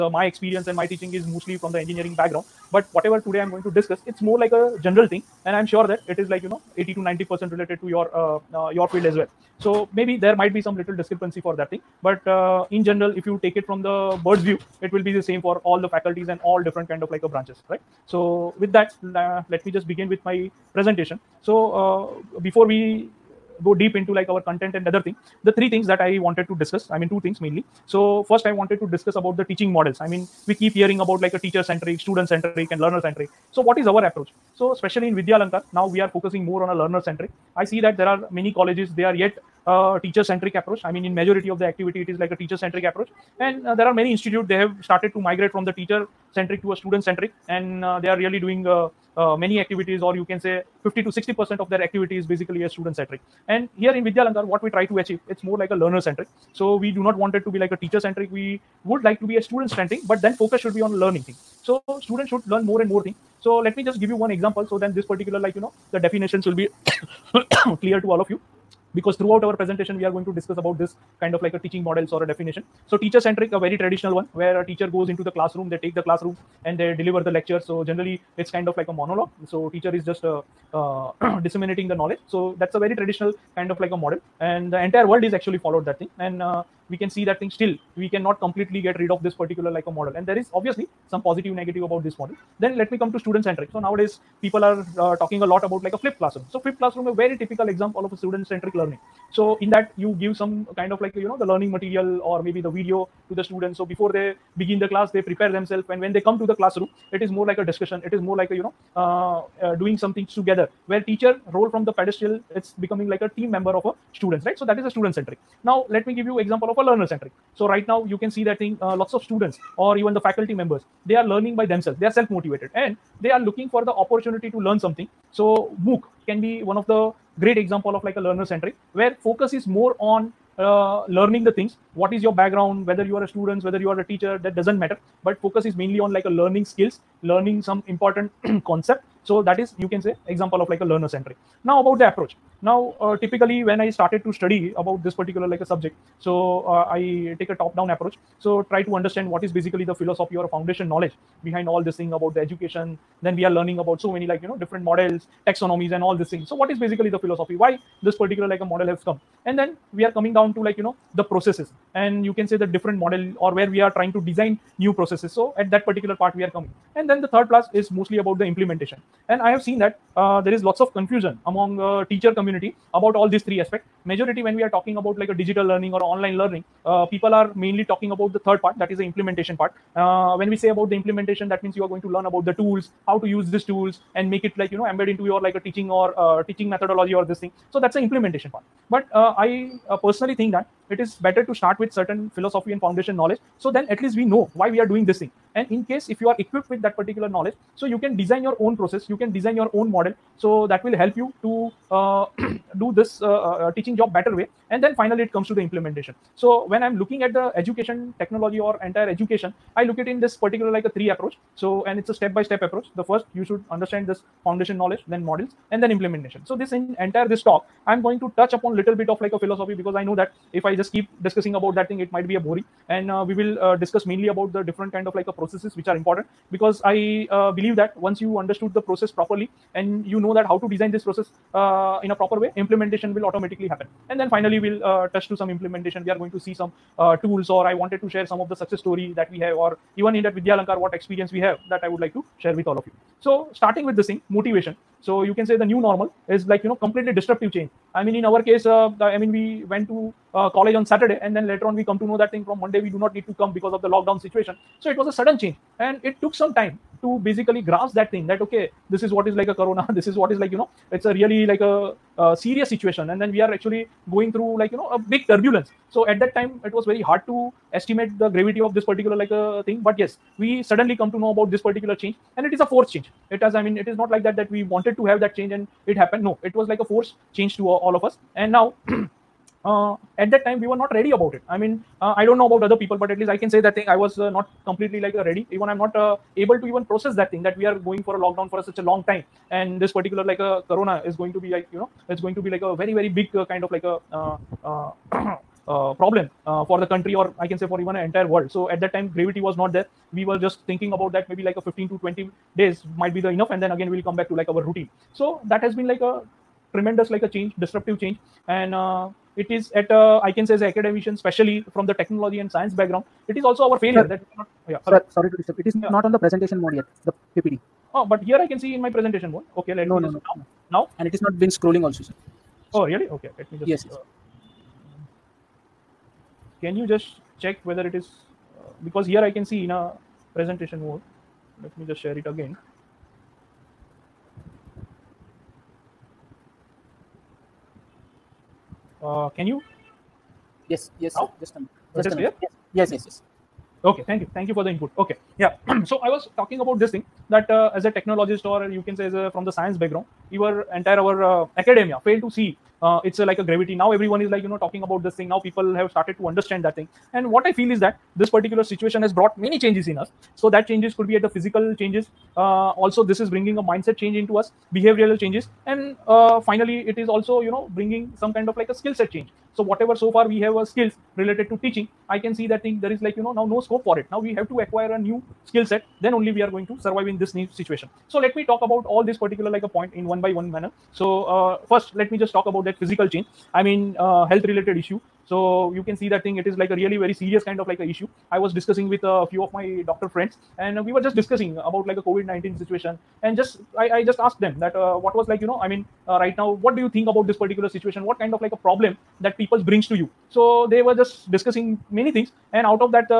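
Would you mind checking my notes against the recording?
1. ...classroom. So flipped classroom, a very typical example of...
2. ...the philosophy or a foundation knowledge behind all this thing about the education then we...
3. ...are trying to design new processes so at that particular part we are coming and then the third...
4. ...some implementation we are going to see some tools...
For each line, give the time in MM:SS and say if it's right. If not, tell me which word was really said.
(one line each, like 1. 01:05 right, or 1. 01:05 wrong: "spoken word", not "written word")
1. 01:36 right
2. 02:29 right
3. 02:43 right
4. 03:55 right.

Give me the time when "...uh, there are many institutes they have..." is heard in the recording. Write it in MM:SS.
00:43.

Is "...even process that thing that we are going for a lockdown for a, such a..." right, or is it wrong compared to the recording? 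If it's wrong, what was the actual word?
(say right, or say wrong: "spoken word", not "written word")
right.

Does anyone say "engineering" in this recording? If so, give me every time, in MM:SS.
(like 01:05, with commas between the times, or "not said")
00:01.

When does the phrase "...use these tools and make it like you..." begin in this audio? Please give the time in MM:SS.
03:03.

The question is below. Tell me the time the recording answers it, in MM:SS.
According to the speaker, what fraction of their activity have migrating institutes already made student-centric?
00:50.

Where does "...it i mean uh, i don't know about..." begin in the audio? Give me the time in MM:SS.
04:41.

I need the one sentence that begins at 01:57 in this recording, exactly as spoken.
So right now you can see that thing.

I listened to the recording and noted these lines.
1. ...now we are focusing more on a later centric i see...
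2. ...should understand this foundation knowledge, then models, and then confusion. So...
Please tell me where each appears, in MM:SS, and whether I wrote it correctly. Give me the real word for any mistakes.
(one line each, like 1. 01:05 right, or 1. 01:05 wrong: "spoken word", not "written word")
1. 00:35 wrong: "learner", not "later"
2. 03:33 wrong: "implementation", not "confusion".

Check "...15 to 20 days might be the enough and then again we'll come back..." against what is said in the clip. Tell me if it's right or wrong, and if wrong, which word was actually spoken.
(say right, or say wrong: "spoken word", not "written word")
right.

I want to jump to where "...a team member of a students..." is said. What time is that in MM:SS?
01:53.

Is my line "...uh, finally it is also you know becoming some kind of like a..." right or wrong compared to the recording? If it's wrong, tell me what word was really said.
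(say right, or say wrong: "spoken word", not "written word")
wrong: "bringing", not "becoming".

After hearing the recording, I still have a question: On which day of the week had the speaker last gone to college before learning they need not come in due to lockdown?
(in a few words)
Saturday.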